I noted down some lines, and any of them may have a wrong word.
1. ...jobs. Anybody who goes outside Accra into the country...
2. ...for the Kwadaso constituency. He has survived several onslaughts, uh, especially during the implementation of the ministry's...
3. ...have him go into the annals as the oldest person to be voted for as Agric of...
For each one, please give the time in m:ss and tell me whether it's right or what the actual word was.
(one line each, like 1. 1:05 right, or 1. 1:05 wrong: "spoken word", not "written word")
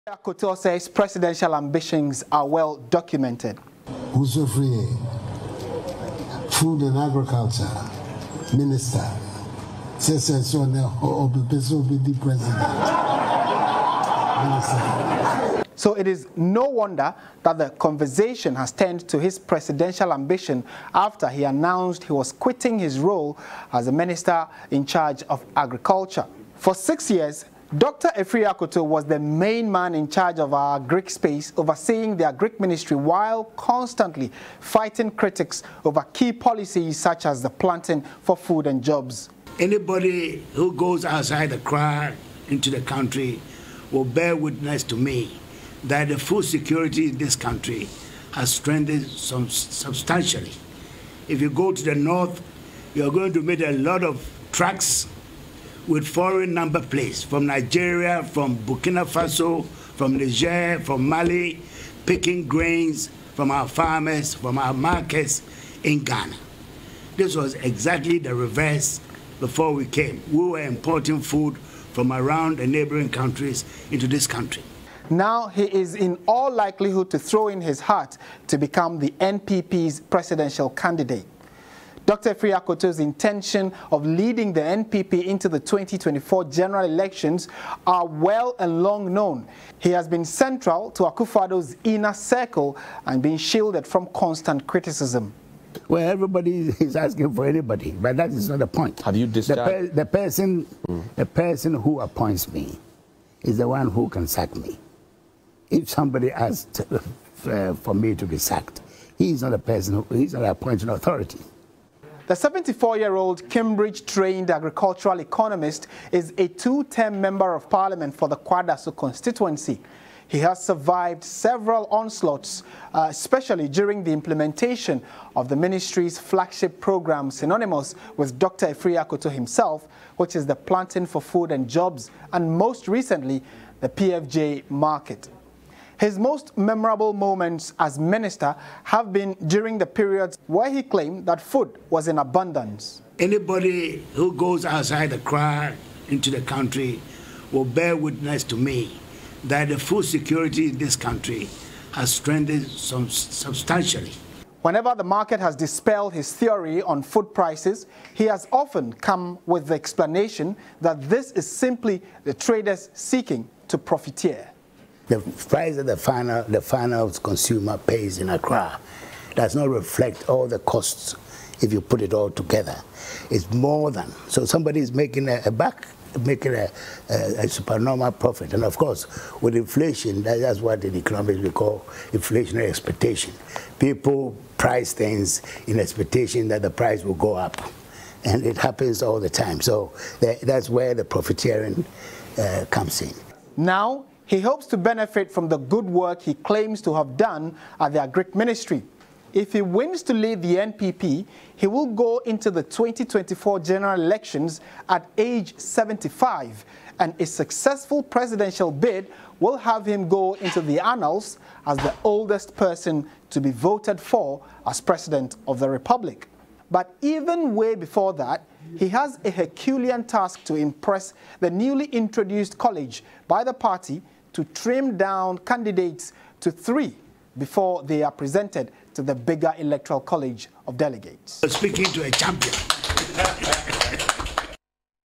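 1. 0:38 right
2. 1:58 right
3. 3:29 wrong: "President", not "Agric".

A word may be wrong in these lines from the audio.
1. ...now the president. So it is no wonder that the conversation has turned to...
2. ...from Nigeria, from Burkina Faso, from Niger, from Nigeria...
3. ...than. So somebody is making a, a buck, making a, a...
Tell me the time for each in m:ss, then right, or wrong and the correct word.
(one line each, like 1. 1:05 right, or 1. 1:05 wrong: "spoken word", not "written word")
1. 0:10 right
2. 0:57 wrong: "Mali", not "Nigeria"
3. 2:53 right.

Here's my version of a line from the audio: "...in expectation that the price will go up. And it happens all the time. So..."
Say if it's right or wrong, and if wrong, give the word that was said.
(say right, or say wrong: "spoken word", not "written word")
right.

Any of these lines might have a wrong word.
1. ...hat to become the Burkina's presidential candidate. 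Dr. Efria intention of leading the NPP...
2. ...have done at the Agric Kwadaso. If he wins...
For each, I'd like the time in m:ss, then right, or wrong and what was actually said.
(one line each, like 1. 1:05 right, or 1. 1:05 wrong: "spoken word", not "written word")
1. 1:17 wrong: "NPP", not "Burkina"
2. 3:16 wrong: "Ministry", not "Kwadaso".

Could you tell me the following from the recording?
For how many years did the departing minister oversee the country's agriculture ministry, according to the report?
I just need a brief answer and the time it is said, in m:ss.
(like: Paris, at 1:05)
6, at 0:26.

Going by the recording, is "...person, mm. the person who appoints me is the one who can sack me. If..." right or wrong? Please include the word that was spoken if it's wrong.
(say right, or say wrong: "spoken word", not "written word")
right.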